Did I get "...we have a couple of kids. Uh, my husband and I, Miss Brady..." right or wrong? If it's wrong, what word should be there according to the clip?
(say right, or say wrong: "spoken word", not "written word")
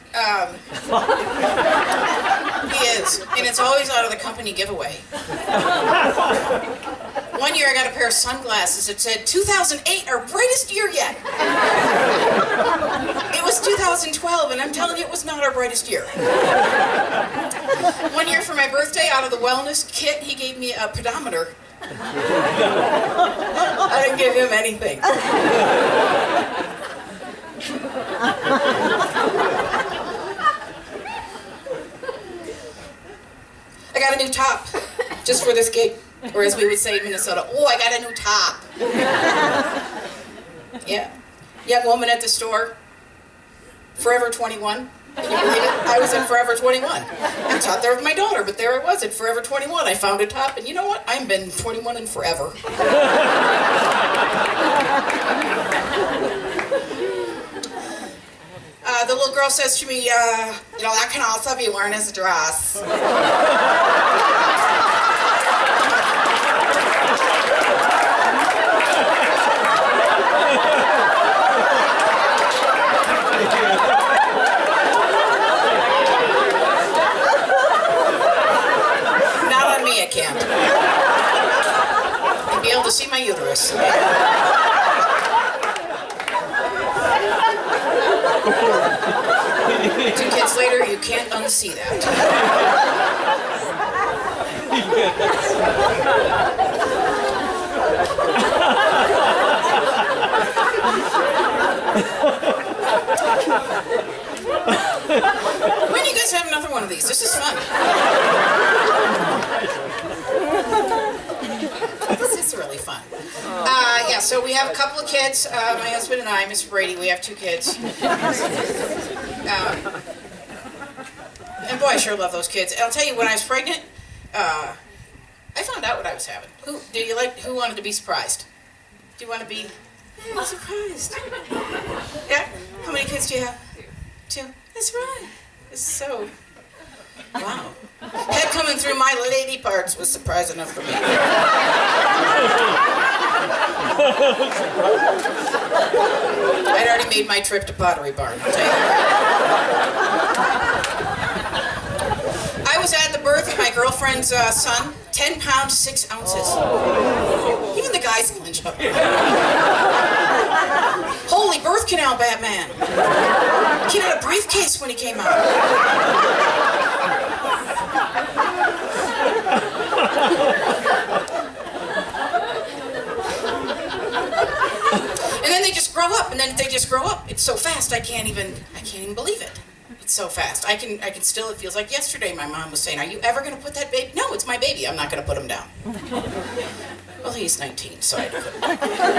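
right.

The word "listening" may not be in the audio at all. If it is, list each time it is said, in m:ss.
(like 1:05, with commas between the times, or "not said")
not said.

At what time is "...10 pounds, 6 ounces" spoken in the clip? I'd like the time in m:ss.
2:35.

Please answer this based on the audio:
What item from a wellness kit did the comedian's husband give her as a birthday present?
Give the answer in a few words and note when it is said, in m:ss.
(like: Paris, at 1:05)
A pedometer, at 0:20.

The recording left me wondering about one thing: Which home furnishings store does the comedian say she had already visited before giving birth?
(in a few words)
Pottery Barn.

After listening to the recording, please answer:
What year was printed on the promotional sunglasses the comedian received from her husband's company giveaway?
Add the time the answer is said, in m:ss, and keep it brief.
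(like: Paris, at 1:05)
2008, at 0:09.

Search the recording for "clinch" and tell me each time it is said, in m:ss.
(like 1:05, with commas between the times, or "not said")
2:38.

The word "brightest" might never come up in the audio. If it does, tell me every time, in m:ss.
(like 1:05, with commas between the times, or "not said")
0:10, 0:15.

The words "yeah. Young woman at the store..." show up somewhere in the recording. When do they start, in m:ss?
0:40.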